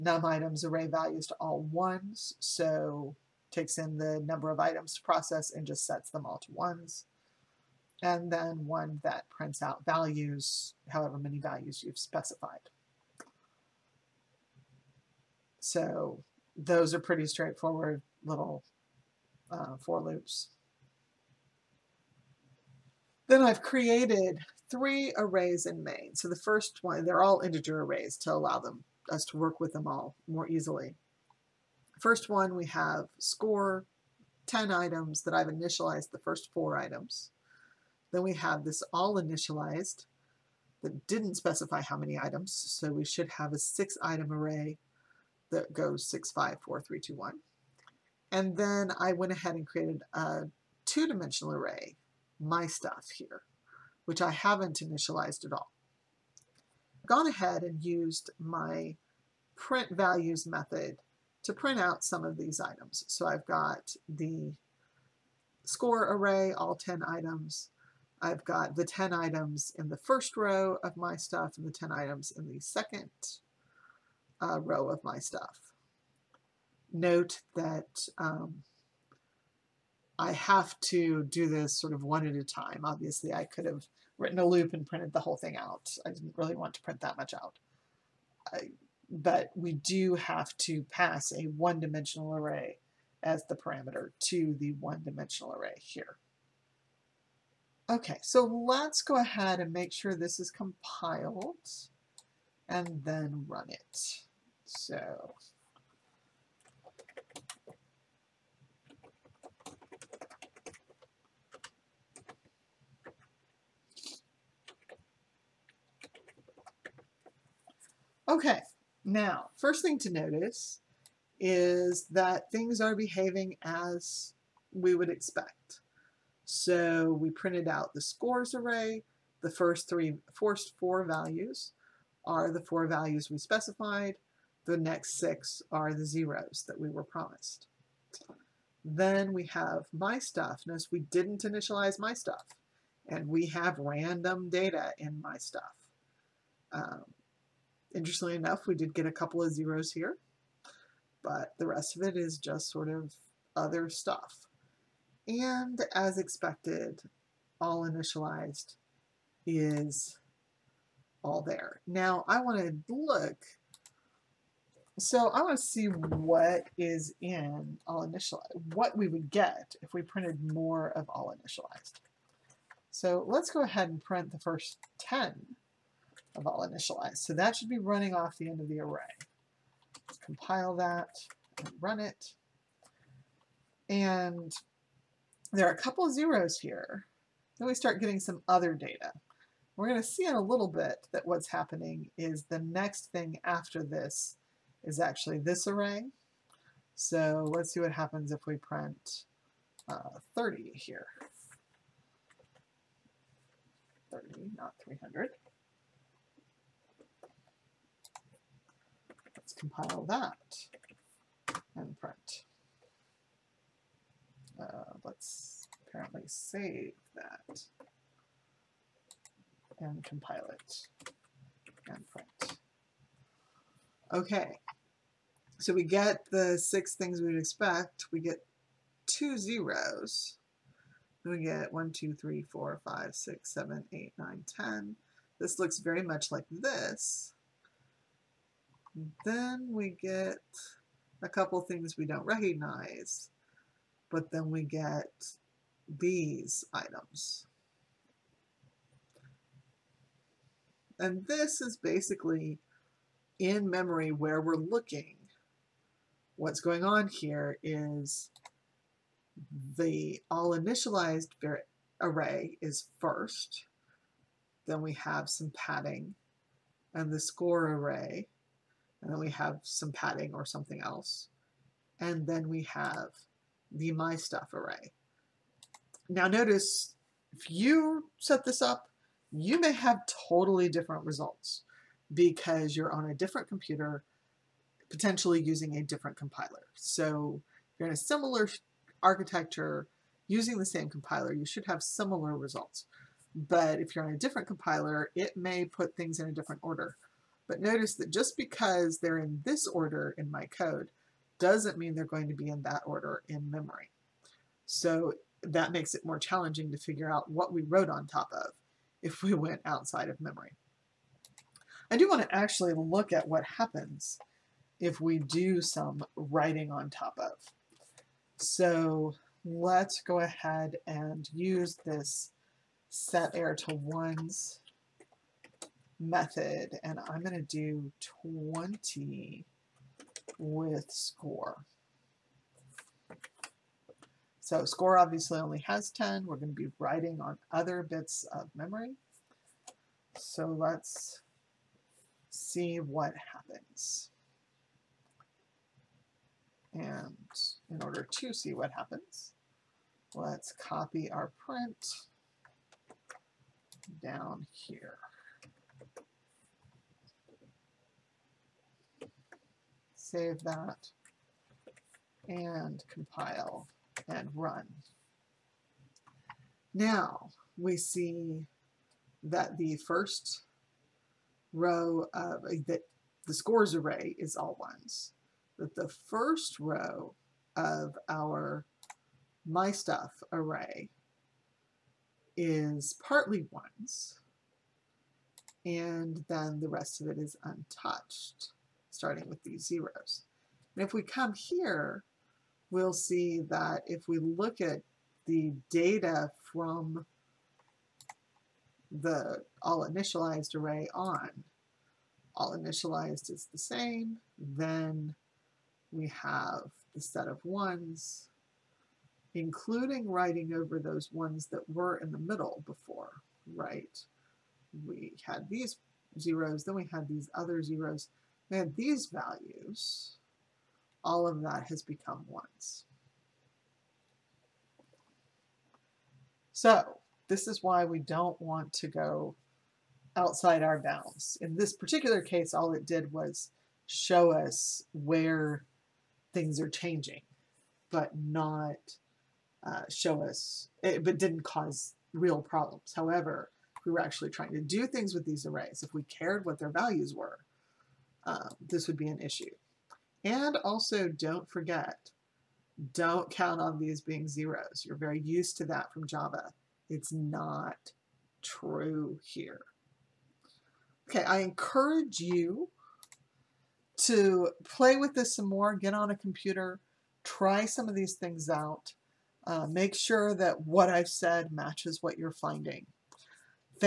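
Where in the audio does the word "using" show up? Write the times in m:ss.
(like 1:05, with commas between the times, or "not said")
4:45, 4:50.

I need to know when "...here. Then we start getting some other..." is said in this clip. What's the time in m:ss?
3:06.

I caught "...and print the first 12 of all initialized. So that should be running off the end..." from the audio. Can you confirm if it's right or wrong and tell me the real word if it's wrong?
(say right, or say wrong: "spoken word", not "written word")
wrong: "10", not "12".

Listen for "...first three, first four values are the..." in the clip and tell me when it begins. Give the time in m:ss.
2:09.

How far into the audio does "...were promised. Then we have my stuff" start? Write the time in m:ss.
2:16.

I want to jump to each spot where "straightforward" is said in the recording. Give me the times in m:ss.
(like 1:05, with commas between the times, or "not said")
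0:17.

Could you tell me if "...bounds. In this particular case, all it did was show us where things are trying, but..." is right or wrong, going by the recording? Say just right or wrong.
wrong.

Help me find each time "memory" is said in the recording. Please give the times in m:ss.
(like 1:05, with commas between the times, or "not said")
4:13, 5:03, 5:10, 5:38.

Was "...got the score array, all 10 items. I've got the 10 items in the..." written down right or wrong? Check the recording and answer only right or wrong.
right.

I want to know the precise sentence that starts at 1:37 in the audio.
Okay, so let's go ahead and make sure this is compiled and then run it.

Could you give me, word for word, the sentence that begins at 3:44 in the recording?
Okay, so we get the six things we'd expect.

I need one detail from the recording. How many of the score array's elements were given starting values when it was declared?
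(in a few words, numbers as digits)
4.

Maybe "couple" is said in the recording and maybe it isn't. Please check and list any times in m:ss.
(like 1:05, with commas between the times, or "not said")
2:29, 3:05, 4:01.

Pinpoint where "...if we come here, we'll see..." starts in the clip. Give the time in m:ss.
6:30.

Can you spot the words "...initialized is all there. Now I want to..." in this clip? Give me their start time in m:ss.
2:37.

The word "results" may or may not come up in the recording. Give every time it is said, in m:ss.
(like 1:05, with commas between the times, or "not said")
4:41, 4:52.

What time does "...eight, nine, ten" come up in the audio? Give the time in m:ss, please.
3:53.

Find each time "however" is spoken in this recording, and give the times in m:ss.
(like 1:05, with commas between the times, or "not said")
0:10, 7:22.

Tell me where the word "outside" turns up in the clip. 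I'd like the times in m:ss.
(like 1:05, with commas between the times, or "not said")
5:09, 7:10.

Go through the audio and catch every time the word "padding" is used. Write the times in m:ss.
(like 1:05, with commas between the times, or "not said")
4:25, 4:29.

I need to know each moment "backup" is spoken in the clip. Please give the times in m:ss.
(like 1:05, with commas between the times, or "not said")
not said.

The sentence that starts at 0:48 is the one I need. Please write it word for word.
And then I went ahead and created a two-dimensional array, my stuff here which I haven't initialized at all.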